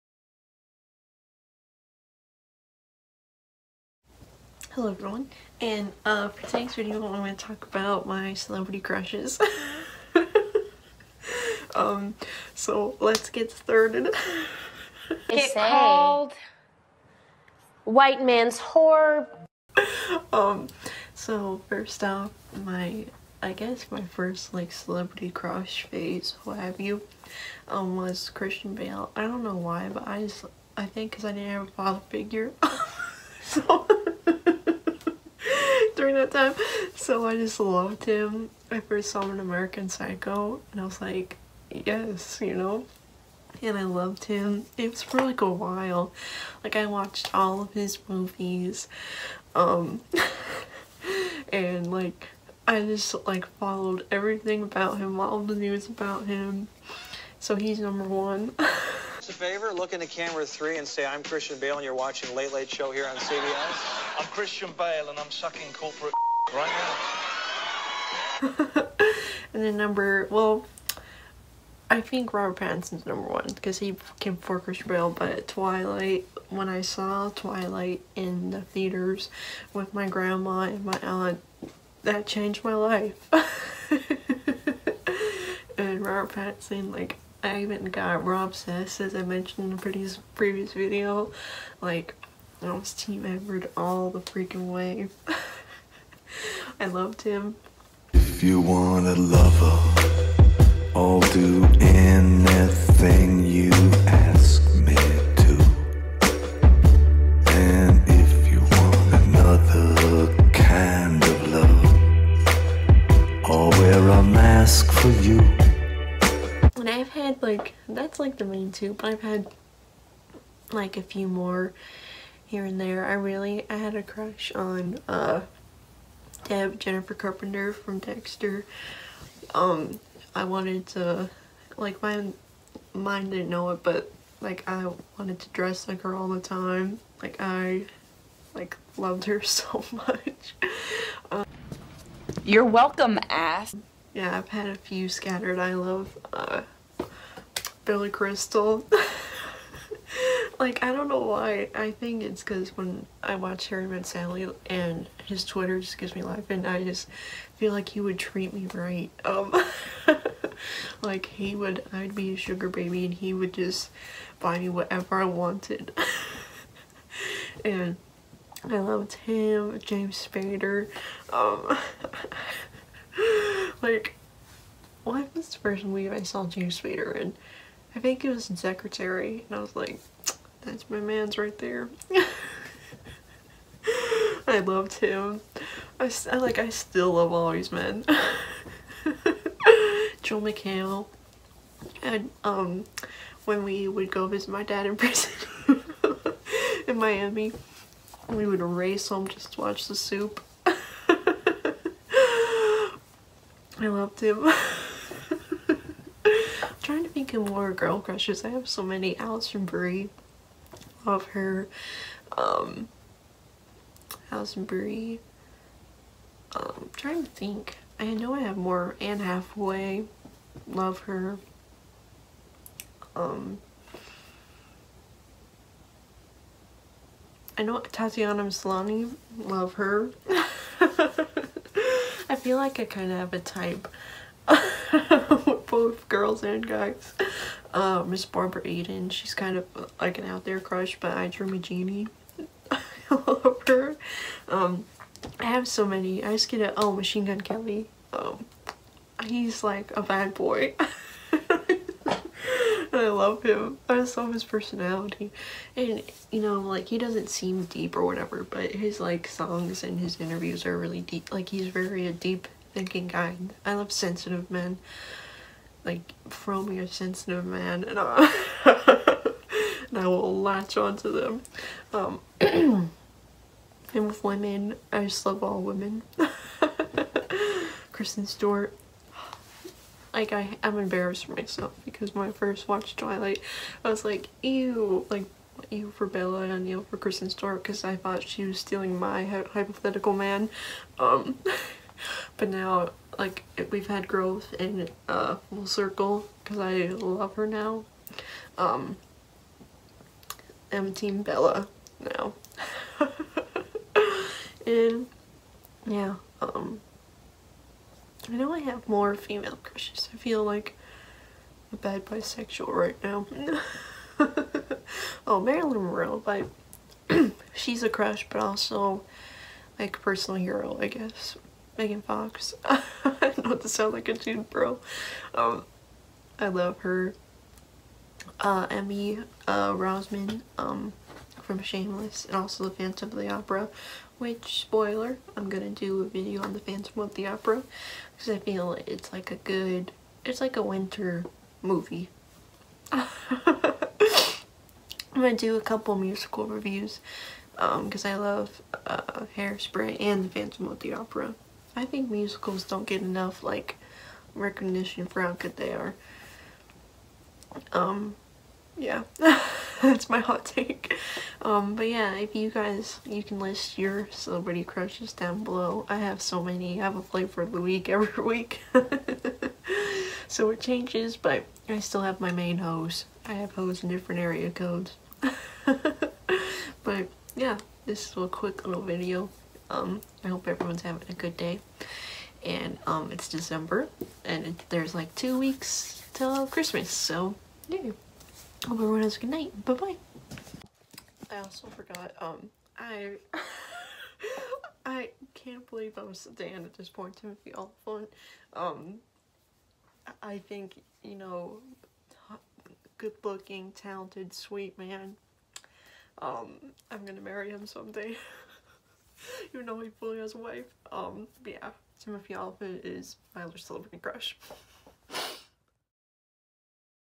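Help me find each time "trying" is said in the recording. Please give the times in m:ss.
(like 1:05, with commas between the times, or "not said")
3:26, 3:36.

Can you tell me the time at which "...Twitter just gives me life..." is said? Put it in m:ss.
2:35.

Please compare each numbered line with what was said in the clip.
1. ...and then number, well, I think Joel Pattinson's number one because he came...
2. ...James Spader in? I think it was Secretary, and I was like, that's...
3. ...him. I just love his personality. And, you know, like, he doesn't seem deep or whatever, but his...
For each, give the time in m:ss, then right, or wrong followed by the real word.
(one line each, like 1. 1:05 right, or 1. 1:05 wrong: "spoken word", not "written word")
1. 1:09 wrong: "Robert", not "Joel"
2. 2:56 right
3. 4:13 right.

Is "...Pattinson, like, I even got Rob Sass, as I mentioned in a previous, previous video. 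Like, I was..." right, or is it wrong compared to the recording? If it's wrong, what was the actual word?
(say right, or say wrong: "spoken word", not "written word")
right.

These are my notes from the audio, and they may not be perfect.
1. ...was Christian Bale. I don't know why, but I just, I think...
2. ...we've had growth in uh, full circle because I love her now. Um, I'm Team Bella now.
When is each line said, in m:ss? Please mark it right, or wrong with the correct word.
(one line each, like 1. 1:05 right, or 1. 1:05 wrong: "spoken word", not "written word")
1. 0:27 right
2. 4:53 right.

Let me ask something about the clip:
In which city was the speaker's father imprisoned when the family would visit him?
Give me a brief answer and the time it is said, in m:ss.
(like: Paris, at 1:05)
Miami, at 3:16.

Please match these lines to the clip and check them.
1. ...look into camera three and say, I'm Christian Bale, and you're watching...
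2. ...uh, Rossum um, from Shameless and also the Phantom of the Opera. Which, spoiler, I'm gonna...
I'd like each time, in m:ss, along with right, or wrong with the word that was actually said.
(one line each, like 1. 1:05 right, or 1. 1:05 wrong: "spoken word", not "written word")
1. 0:59 right
2. 5:29 right.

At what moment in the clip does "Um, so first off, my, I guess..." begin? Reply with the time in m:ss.
0:20.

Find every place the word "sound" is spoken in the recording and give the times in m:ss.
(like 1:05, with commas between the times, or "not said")
5:23.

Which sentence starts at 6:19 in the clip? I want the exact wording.
Um, I hope everyone's having a good day.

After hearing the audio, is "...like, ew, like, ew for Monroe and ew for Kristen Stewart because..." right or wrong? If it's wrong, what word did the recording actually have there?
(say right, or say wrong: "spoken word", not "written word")
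wrong: "Bella", not "Monroe".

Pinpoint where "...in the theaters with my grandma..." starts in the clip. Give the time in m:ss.
1:18.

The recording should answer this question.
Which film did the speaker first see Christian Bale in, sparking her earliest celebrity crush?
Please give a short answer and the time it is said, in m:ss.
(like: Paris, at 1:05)
American Psycho, at 0:39.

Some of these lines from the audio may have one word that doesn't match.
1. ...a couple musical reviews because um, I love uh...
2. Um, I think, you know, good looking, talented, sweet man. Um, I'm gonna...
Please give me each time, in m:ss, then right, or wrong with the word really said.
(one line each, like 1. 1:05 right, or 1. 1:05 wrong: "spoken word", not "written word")
1. 5:45 right
2. 6:38 right.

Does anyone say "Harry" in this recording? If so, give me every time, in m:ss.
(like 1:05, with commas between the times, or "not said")
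2:33.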